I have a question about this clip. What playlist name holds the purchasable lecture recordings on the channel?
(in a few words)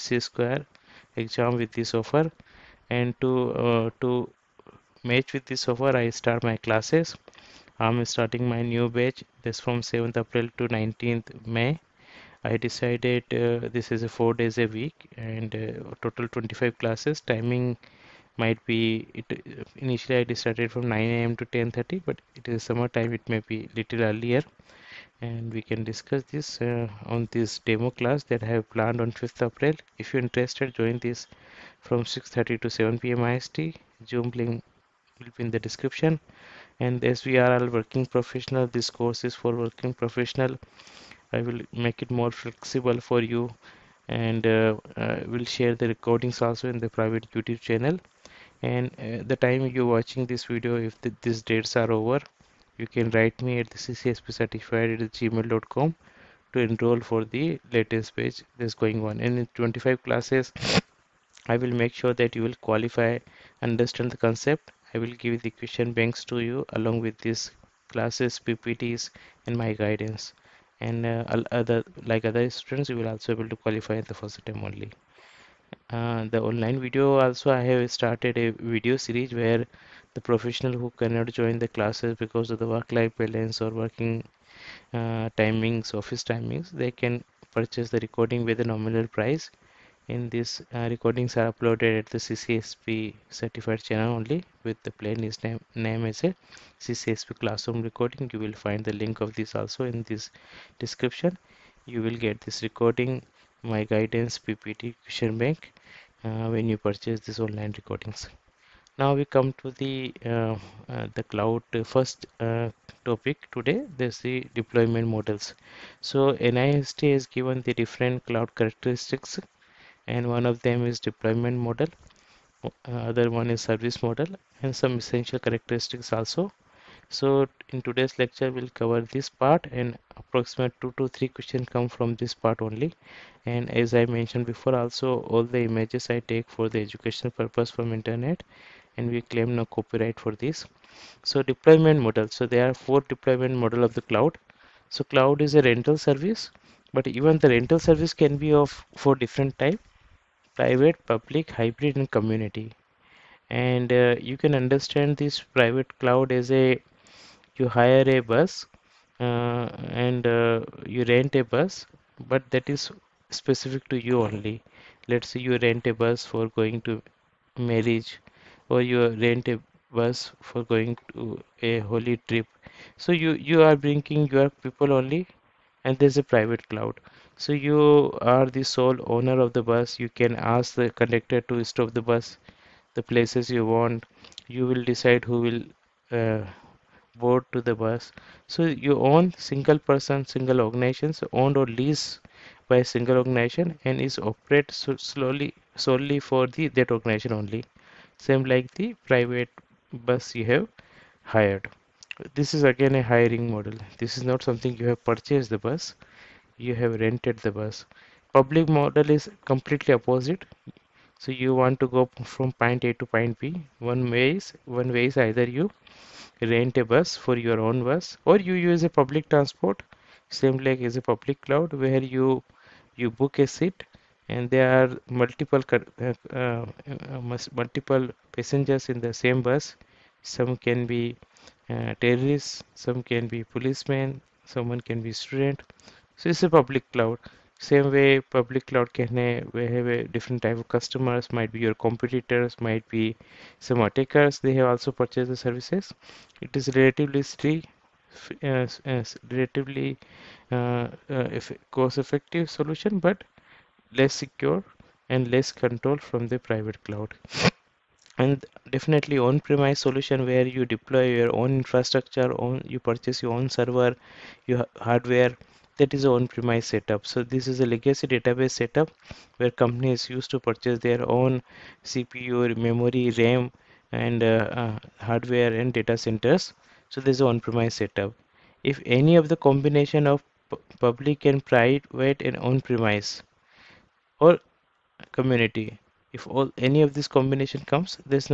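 CCSP classroom recording.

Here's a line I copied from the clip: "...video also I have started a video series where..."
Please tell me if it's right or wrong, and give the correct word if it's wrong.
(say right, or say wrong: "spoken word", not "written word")
right.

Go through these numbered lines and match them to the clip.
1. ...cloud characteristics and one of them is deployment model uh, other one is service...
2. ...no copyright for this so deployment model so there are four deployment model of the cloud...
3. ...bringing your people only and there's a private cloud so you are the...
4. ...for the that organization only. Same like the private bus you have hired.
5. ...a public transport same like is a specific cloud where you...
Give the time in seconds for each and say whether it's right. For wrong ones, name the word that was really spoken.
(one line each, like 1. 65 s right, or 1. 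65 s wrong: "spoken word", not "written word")
1. 118 s right
2. 139 s right
3. 173 s right
4. 196 s right
5. 218 s wrong: "public", not "specific".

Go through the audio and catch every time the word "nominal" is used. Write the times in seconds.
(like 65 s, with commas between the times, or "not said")
88 s.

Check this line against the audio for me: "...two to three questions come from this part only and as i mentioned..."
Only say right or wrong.
right.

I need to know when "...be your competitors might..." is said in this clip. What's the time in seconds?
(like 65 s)
241 s.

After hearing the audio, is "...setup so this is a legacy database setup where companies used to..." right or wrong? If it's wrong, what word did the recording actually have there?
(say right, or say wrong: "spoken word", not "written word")
right.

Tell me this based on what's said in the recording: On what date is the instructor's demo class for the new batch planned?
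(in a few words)
5th April.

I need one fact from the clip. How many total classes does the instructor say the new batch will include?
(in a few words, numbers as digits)
25.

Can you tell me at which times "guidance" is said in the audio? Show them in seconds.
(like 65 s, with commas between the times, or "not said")
69 s, 103 s.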